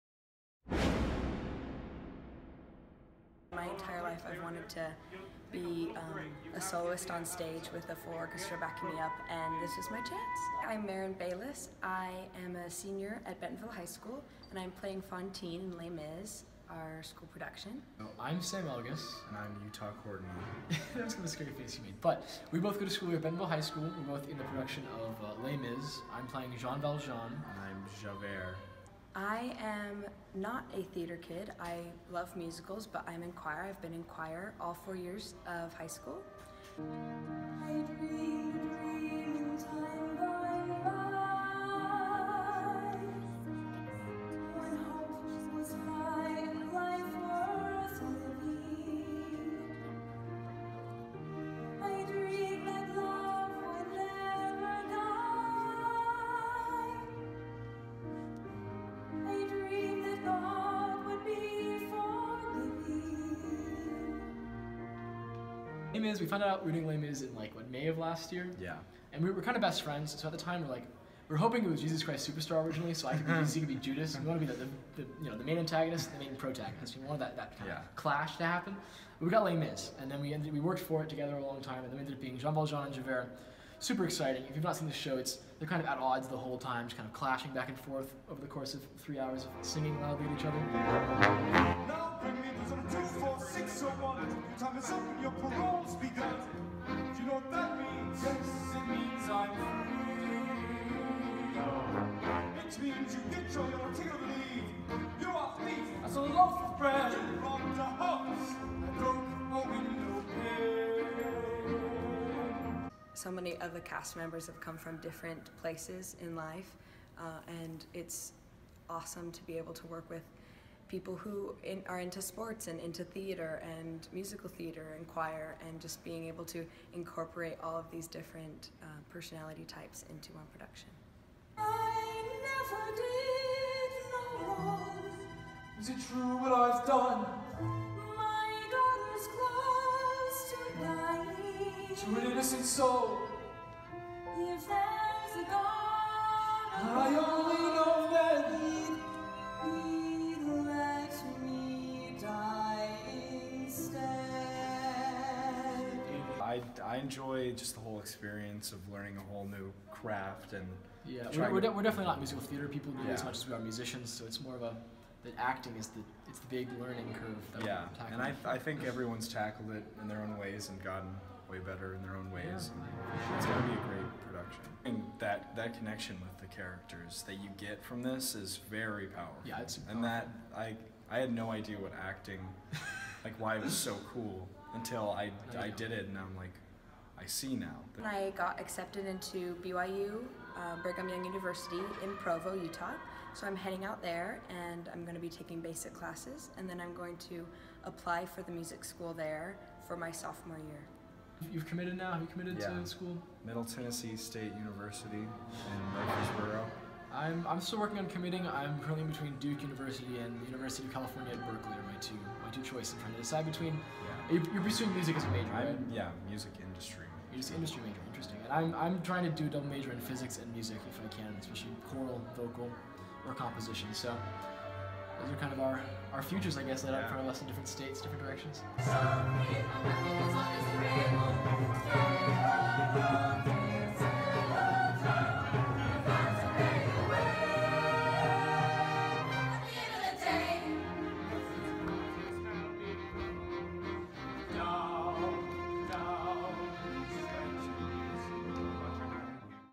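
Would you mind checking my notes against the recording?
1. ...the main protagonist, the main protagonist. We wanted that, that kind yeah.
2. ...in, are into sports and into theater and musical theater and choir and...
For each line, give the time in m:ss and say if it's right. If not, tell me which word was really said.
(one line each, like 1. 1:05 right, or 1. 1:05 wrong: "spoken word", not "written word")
1. 1:15 wrong: "antagonist", not "protagonist"
2. 2:01 right.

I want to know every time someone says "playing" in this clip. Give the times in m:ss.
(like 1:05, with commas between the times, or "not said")
0:14, 0:26.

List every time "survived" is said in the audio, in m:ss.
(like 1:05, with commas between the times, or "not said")
not said.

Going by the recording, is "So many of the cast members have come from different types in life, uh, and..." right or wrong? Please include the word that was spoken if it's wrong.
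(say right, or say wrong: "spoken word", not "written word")
wrong: "places", not "types".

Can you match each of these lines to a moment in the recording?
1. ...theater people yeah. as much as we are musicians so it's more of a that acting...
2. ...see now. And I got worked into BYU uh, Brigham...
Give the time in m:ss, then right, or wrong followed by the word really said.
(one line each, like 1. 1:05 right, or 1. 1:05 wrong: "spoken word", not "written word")
1. 2:42 right
2. 3:07 wrong: "accepted", not "worked".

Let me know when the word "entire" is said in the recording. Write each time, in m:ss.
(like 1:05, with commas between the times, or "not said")
0:03.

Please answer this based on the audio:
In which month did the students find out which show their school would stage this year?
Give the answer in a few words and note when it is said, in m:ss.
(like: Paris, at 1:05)
May, at 1:07.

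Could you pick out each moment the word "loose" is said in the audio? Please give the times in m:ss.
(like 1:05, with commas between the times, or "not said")
not said.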